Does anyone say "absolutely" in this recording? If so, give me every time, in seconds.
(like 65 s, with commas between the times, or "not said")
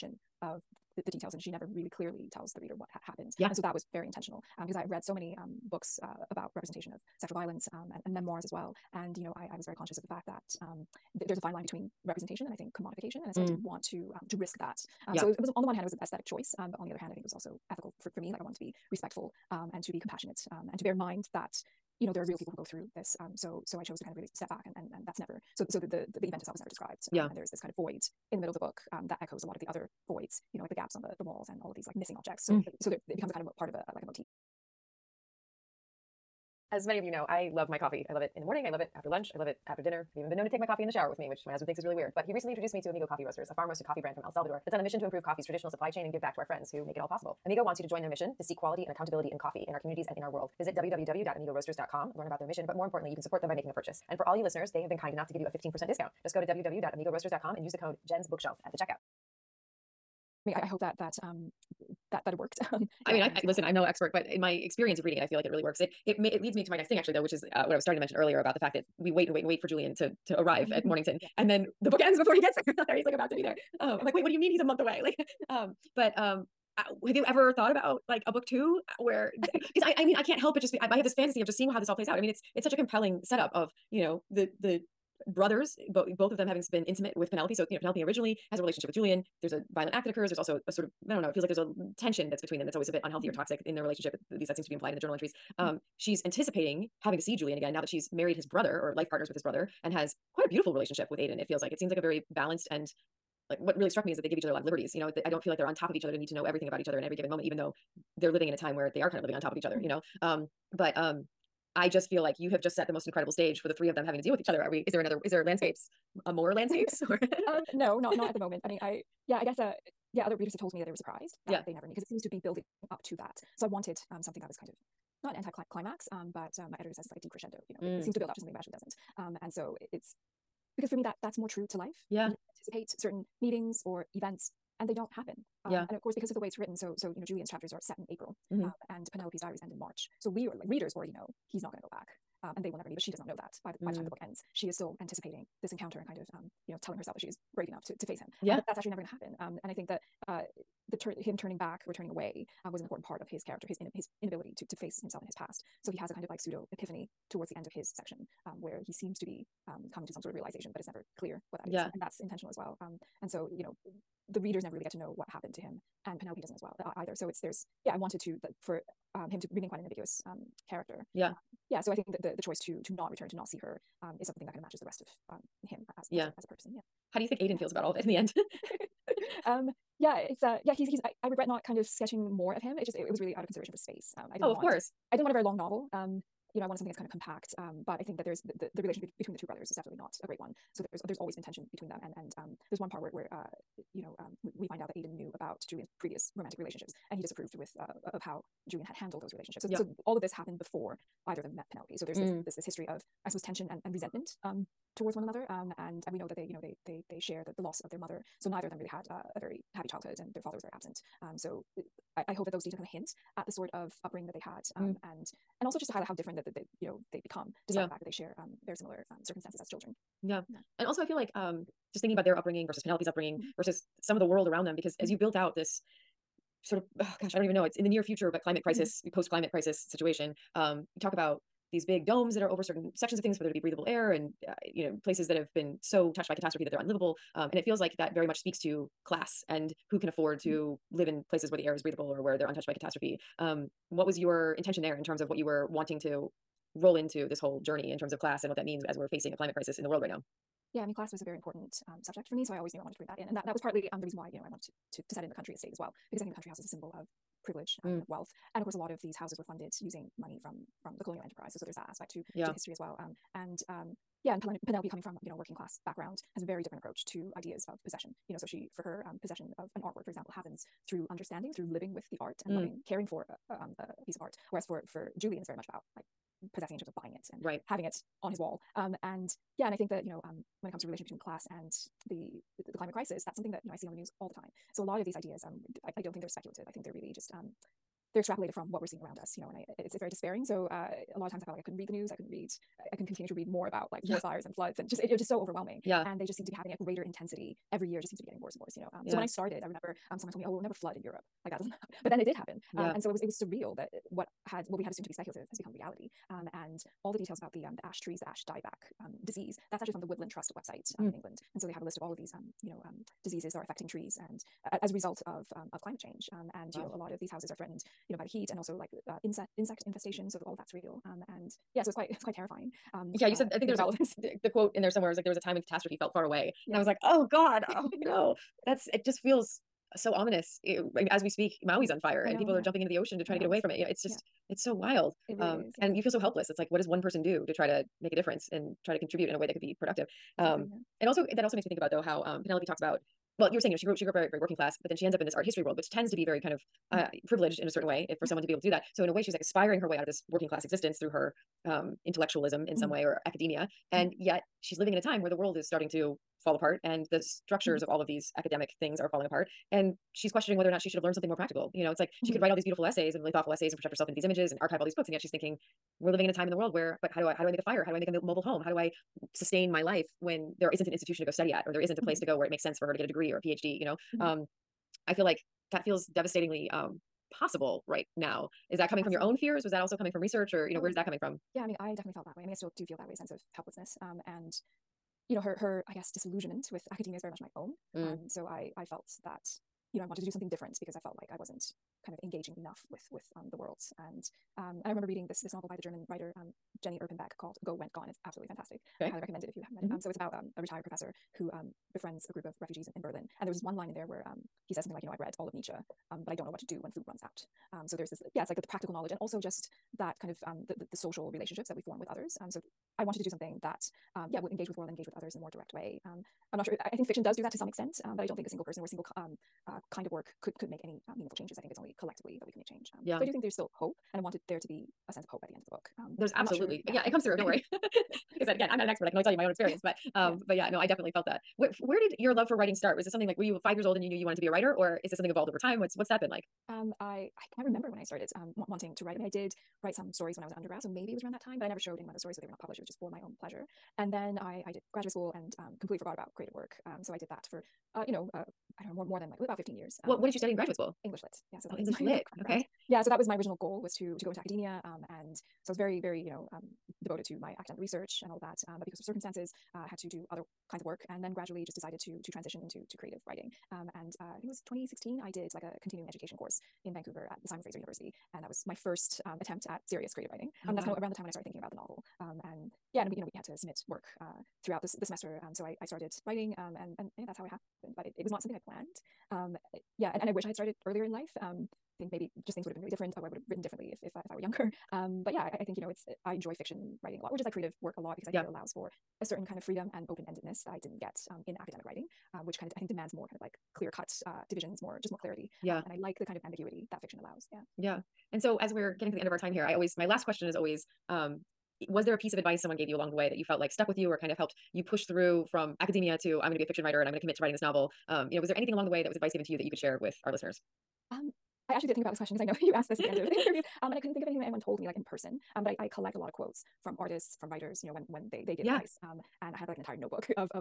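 398 s, 426 s.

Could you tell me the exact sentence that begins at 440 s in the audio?
So maybe it was around that time, but I never showed anyone those stories.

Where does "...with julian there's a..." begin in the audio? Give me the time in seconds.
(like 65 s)
88 s.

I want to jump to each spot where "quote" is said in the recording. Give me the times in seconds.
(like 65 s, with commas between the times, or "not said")
324 s, 516 s.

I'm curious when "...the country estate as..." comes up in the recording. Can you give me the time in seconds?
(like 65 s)
255 s.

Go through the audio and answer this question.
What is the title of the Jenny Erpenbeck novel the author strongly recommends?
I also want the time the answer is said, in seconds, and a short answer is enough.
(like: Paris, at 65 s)
Go Went Gone, at 397 s.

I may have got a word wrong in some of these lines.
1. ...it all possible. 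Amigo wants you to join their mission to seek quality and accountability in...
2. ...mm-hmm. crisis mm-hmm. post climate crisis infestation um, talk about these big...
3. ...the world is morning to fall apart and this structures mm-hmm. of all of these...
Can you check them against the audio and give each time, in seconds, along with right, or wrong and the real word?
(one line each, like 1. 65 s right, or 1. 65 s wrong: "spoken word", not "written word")
1. 46 s right
2. 228 s wrong: "situation", not "infestation"
3. 355 s wrong: "starting", not "morning".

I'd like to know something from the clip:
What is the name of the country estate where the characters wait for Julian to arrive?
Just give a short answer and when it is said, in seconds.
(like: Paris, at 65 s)
Mornington, at 70 s.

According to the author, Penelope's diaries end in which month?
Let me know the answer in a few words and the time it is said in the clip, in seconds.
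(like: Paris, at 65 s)
March, at 139 s.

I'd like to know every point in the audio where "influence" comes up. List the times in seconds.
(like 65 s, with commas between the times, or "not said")
not said.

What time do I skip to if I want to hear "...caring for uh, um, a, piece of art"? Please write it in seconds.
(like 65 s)
272 s.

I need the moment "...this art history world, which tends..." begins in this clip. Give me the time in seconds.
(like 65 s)
345 s.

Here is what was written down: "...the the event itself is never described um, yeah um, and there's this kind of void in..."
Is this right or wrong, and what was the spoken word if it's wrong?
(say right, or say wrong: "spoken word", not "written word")
right.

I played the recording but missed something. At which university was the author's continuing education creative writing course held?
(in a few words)
Simon Fraser University.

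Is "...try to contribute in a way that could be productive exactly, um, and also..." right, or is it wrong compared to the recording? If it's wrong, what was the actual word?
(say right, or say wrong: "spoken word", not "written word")
right.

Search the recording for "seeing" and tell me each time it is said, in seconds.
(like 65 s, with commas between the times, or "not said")
81 s, 288 s.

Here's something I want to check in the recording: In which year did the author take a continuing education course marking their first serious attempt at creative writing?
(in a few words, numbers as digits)
2016.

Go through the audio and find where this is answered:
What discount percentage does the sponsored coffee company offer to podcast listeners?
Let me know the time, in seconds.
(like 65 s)
55 s.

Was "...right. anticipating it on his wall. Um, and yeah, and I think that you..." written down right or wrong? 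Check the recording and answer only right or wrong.
wrong.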